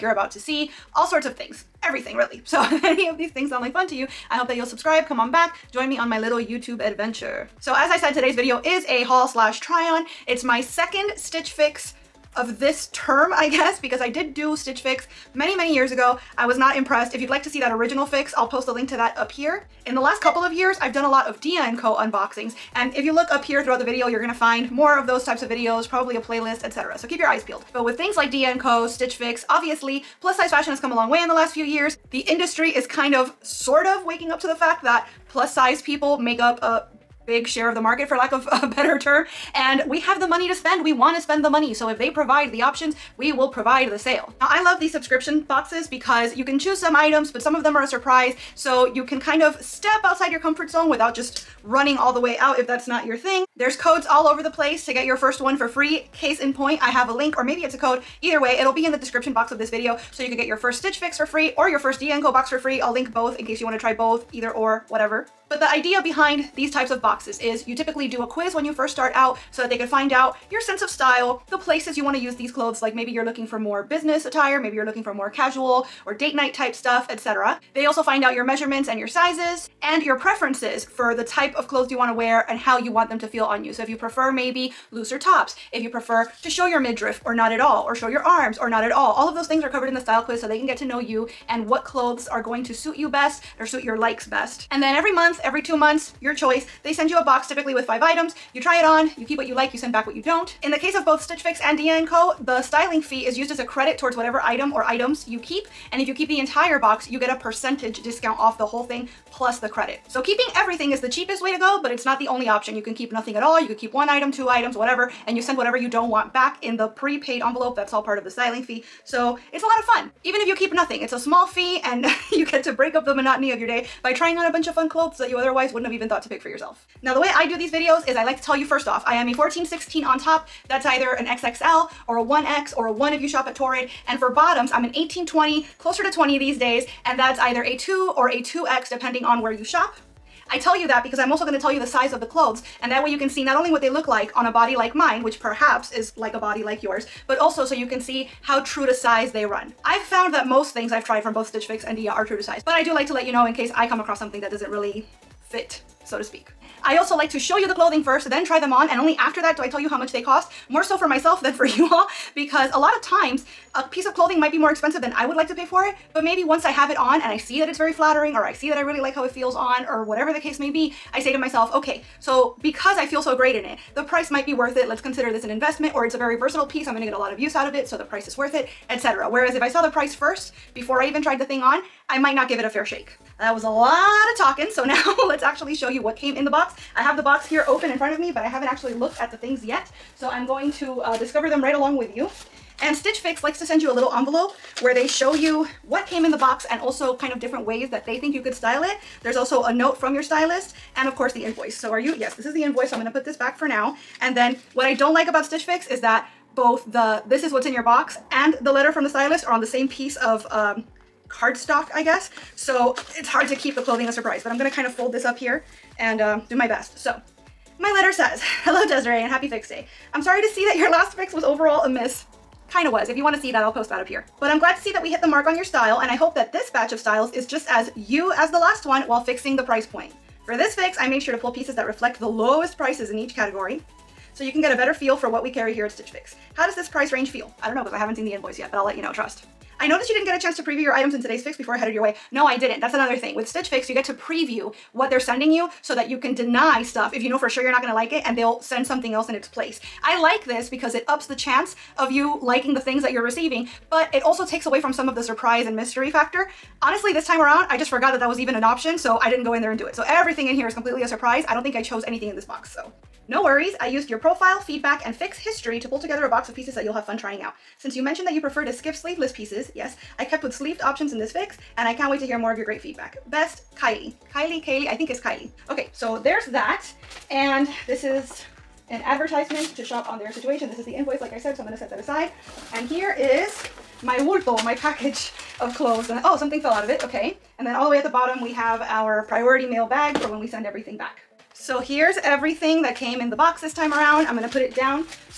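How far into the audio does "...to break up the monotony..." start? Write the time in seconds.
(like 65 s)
122 s.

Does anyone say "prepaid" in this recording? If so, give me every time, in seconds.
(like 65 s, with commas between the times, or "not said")
116 s.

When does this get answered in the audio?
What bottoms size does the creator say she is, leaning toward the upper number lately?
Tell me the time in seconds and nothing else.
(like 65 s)
134 s.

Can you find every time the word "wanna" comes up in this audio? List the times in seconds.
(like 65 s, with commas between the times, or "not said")
63 s, 223 s.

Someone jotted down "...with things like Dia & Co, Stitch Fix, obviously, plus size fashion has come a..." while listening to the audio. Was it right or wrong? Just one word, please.
right.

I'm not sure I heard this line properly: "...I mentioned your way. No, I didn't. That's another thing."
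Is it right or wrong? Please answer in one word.
wrong.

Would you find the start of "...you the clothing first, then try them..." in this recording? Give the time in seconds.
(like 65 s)
157 s.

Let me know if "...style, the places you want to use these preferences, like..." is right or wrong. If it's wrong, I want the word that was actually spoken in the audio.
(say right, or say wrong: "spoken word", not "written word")
wrong: "clothes", not "preferences".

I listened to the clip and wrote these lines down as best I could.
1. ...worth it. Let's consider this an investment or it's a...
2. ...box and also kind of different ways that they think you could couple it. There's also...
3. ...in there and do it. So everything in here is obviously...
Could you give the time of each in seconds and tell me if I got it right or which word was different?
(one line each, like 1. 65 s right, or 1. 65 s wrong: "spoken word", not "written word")
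1. 174 s right
2. 196 s wrong: "style", not "couple"
3. 259 s wrong: "completely", not "obviously".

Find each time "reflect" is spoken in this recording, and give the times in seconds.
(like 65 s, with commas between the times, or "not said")
231 s.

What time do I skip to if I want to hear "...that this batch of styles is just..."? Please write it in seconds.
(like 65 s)
226 s.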